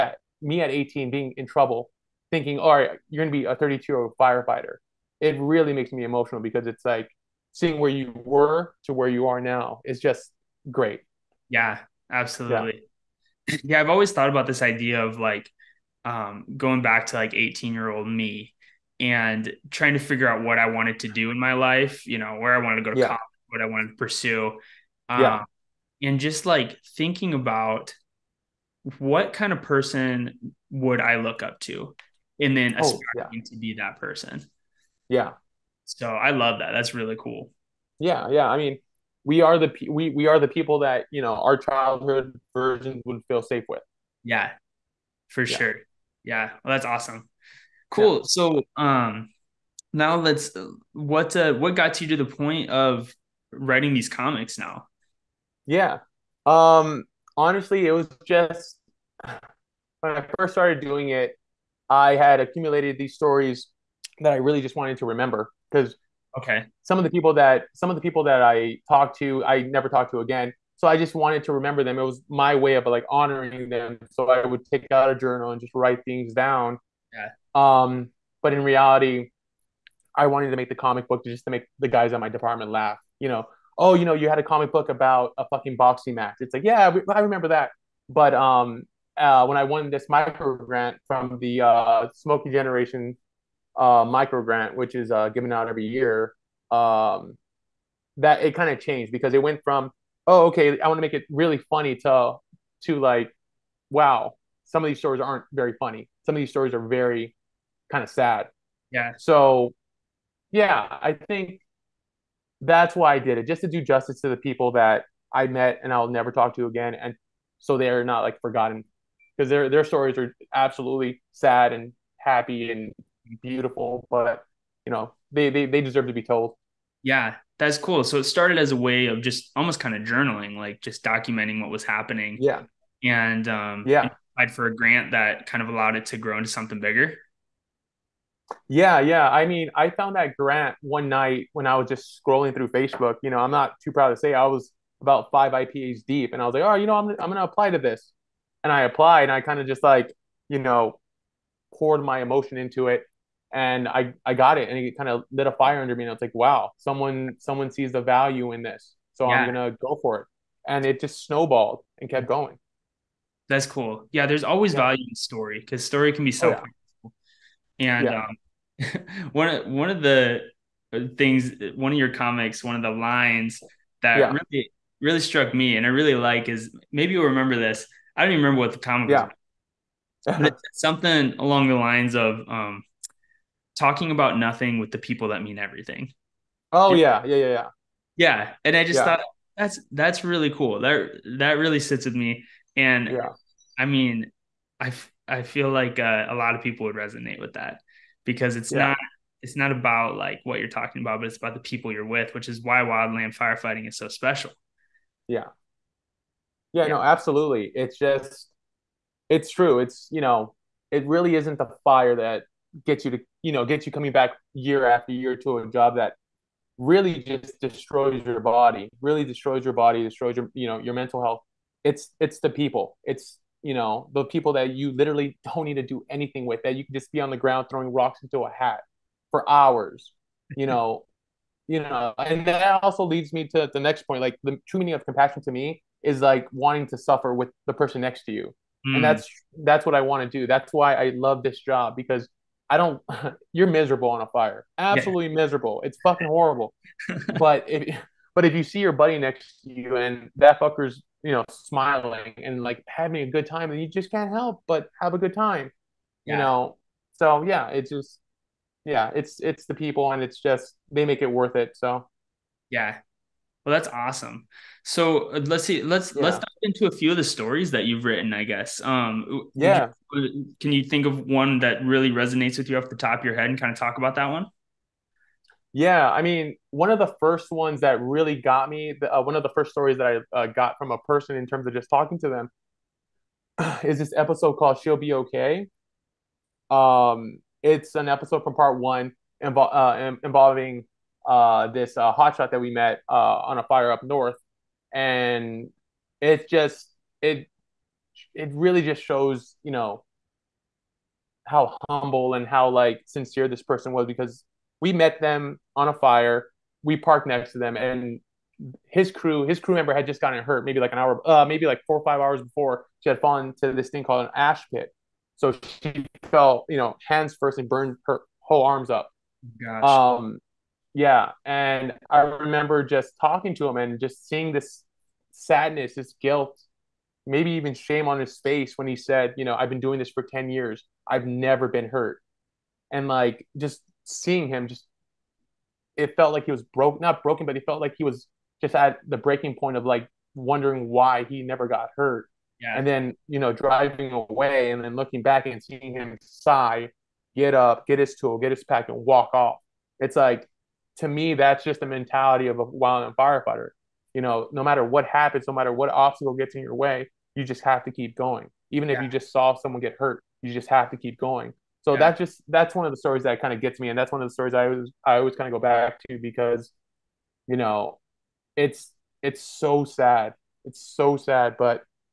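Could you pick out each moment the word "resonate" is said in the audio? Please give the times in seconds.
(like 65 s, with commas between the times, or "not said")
196 s, 272 s.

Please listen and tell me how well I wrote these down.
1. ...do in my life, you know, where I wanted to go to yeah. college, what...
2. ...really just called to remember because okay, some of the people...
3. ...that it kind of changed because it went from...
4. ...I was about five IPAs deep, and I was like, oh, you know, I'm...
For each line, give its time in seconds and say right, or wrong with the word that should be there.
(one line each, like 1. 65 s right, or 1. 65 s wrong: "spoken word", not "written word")
1. 21 s right
2. 64 s wrong: "wanted", not "called"
3. 98 s right
4. 144 s right.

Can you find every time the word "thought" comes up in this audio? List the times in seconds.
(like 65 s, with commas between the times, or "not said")
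14 s, 189 s.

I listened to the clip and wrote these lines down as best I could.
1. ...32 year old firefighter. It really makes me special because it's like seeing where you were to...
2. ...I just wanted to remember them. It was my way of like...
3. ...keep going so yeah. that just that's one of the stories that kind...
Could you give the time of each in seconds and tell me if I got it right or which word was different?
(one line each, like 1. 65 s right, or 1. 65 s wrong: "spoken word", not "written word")
1. 3 s wrong: "emotional", not "special"
2. 70 s right
3. 360 s right.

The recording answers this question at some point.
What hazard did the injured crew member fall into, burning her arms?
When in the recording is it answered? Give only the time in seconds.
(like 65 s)
314 s.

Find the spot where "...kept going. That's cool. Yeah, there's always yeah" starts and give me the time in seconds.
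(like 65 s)
162 s.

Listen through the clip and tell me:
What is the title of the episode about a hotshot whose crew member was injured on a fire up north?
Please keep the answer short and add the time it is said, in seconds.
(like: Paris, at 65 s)
She'll Be Okay, at 284 s.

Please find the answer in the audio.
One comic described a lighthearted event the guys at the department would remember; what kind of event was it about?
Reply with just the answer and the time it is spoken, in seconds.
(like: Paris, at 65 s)
boxing match, at 85 s.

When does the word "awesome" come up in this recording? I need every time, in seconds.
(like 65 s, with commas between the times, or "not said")
46 s, 263 s.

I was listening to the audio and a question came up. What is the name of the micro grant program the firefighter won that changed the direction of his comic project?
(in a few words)
Smokey Generation.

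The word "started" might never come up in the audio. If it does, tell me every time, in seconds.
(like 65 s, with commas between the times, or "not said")
60 s, 128 s.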